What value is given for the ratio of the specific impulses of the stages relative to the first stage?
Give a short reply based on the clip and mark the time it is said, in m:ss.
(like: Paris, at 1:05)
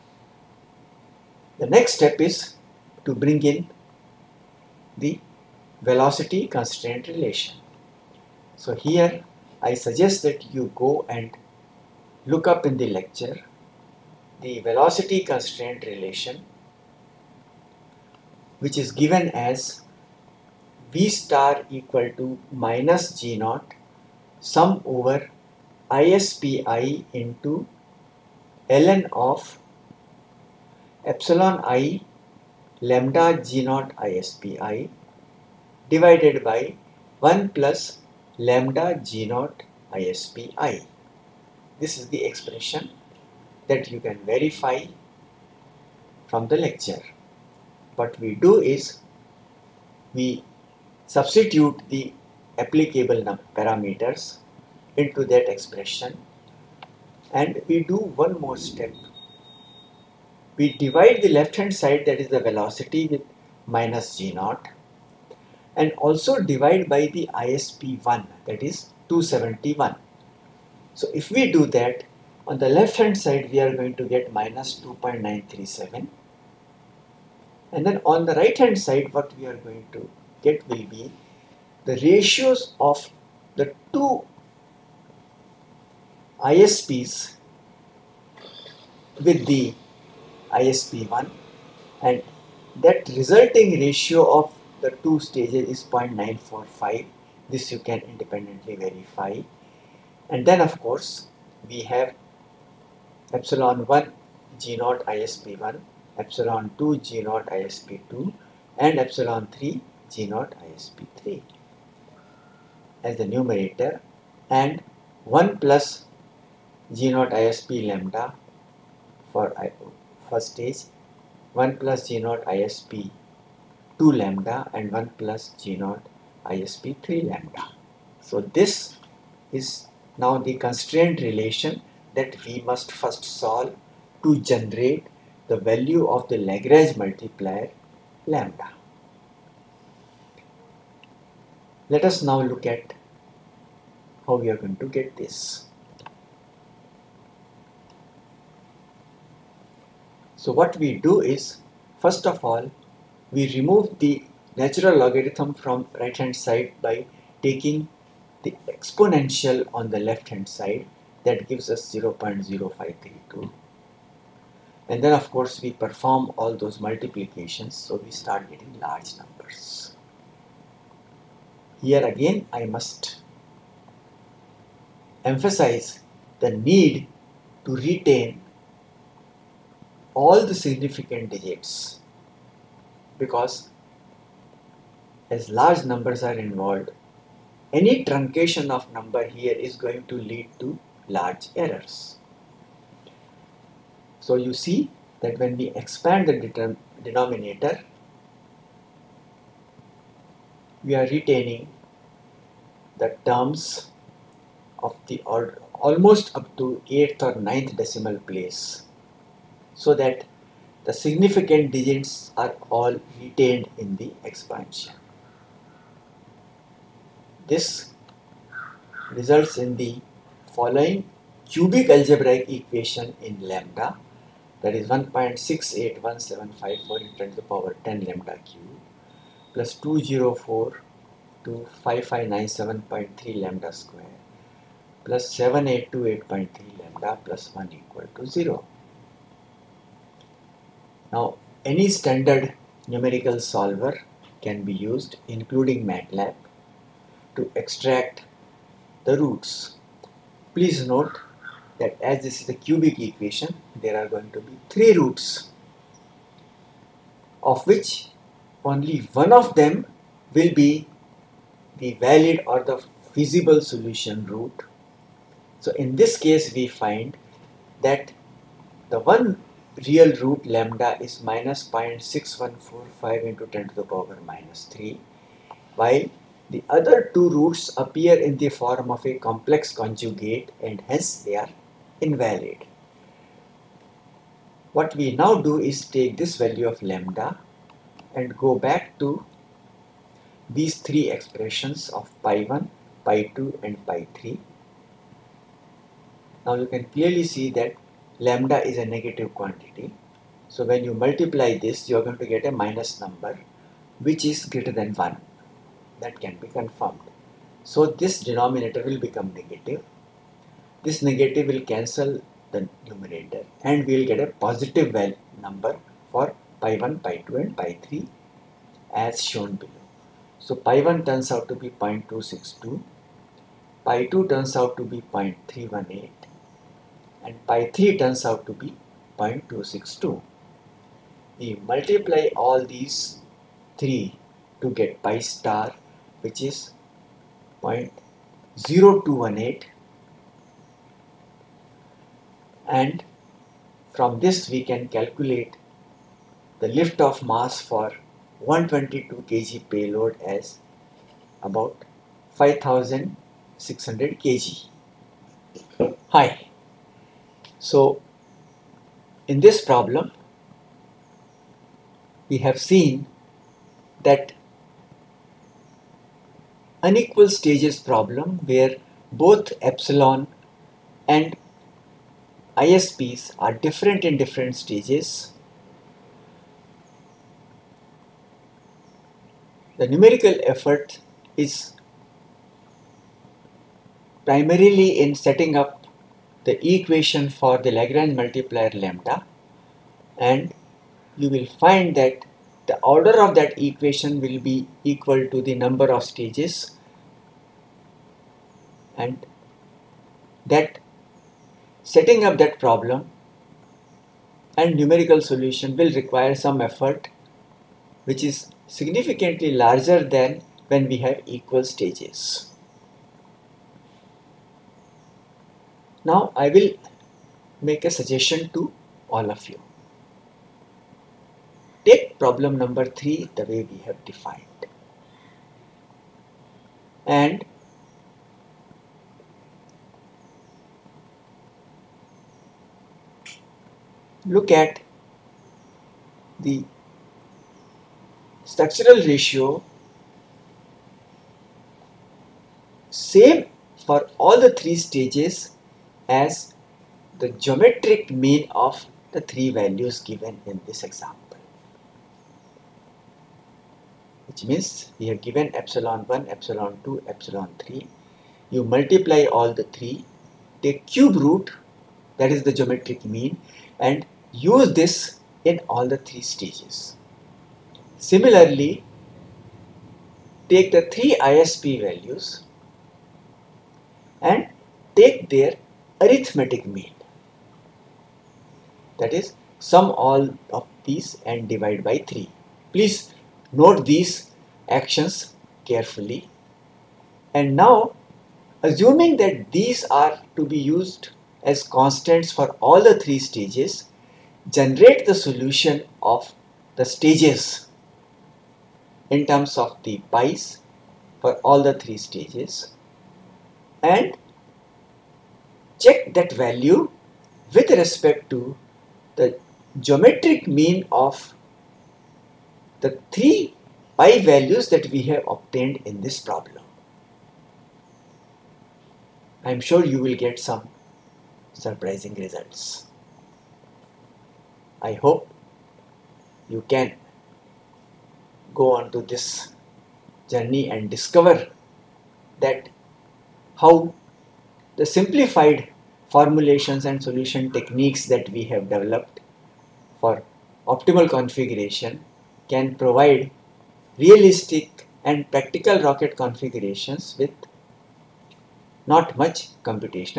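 0.945, at 1:35.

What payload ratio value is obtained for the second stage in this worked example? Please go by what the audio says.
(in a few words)
0.318.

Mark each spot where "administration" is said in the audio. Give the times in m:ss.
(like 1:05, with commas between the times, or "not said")
not said.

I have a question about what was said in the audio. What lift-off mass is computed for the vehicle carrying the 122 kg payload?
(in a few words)
5600 kg.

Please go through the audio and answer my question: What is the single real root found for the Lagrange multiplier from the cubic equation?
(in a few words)
-0.6145 × 10^-3.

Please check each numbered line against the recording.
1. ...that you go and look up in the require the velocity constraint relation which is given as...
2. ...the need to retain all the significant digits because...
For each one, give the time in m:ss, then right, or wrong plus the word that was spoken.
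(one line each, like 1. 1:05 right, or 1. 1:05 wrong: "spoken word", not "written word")
1. 0:10 wrong: "lecture", not "require"
2. 2:56 right.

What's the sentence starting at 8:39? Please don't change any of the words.
I am sure you will get some surprising results.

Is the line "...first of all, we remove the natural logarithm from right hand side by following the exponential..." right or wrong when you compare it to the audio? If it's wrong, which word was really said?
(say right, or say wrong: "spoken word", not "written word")
wrong: "taking", not "following".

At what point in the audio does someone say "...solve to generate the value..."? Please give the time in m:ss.
2:13.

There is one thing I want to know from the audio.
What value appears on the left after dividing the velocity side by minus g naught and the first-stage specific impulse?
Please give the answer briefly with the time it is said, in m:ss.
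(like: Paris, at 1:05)
-2.937, at 1:14.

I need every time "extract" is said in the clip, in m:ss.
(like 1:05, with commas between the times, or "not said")
4:07.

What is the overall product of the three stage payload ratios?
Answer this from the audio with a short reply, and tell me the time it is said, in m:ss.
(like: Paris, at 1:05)
0.0218, at 5:37.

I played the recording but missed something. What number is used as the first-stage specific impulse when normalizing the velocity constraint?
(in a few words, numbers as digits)
271.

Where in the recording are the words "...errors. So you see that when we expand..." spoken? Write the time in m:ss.
3:11.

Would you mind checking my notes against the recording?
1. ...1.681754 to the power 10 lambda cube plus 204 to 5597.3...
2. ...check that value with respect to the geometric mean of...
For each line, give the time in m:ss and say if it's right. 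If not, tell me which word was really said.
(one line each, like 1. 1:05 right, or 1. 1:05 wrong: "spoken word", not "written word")
1. 3:44 right
2. 8:25 right.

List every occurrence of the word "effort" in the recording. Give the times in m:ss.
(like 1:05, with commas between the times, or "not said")
6:20, 6:46.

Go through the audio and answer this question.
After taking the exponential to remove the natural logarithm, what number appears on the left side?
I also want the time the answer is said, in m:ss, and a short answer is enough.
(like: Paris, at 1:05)
0.0532, at 2:41.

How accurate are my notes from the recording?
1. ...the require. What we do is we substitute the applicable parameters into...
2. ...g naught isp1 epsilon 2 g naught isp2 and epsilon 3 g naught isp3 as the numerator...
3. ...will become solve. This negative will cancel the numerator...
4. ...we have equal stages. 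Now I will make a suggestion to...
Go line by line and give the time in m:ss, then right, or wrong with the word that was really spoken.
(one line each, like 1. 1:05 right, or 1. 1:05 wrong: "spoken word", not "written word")
1. 0:46 wrong: "lecture", not "require"
2. 1:44 right
3. 5:08 wrong: "negative", not "solve"
4. 6:50 right.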